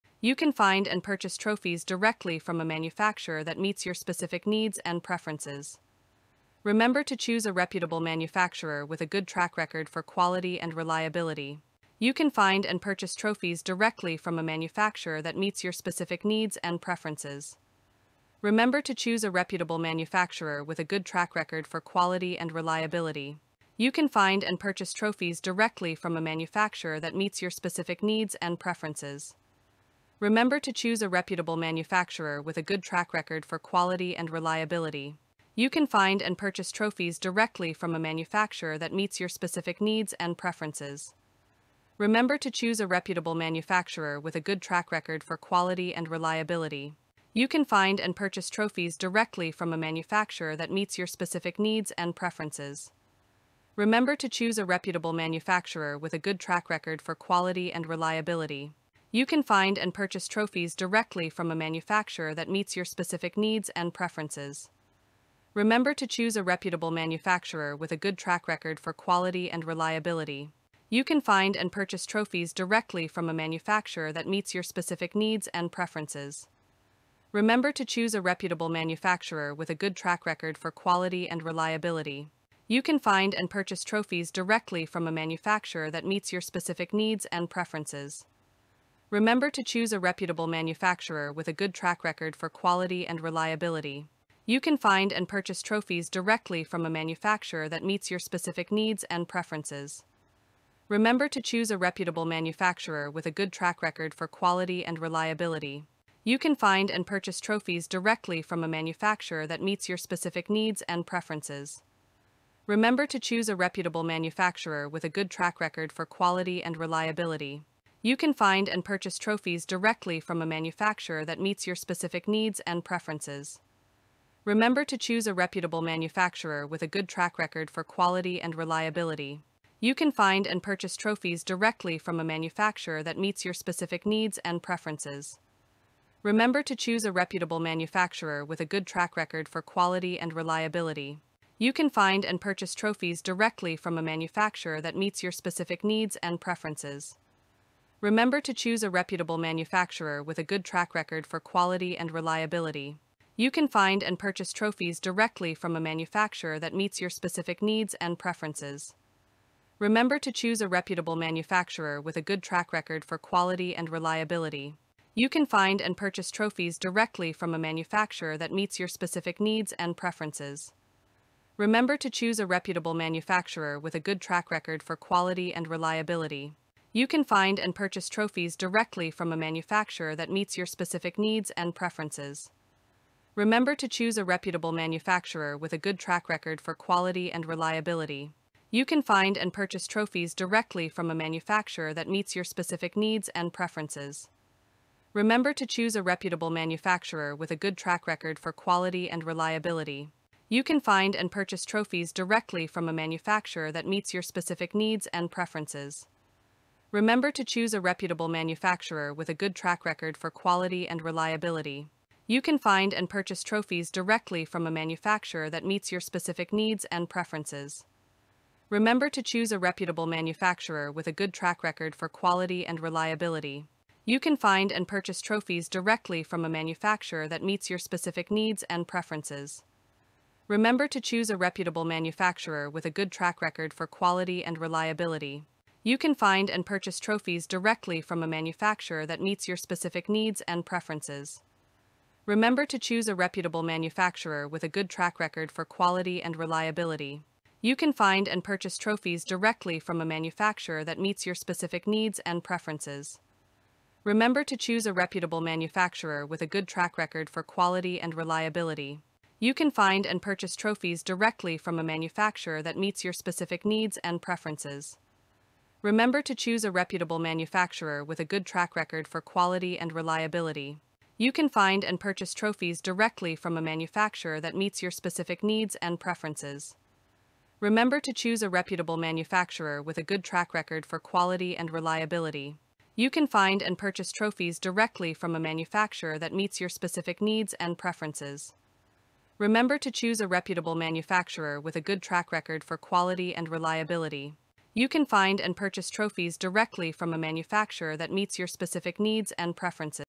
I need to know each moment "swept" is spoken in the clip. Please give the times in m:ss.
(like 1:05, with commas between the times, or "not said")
not said.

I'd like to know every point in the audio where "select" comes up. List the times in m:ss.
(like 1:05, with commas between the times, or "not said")
not said.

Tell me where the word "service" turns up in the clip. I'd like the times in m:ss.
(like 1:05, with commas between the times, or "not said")
not said.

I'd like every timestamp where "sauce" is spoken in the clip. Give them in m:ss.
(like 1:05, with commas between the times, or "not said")
not said.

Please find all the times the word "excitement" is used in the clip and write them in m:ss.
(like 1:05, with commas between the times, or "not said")
not said.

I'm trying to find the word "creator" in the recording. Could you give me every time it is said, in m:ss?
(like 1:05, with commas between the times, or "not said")
not said.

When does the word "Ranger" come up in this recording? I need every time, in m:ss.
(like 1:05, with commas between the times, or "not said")
not said.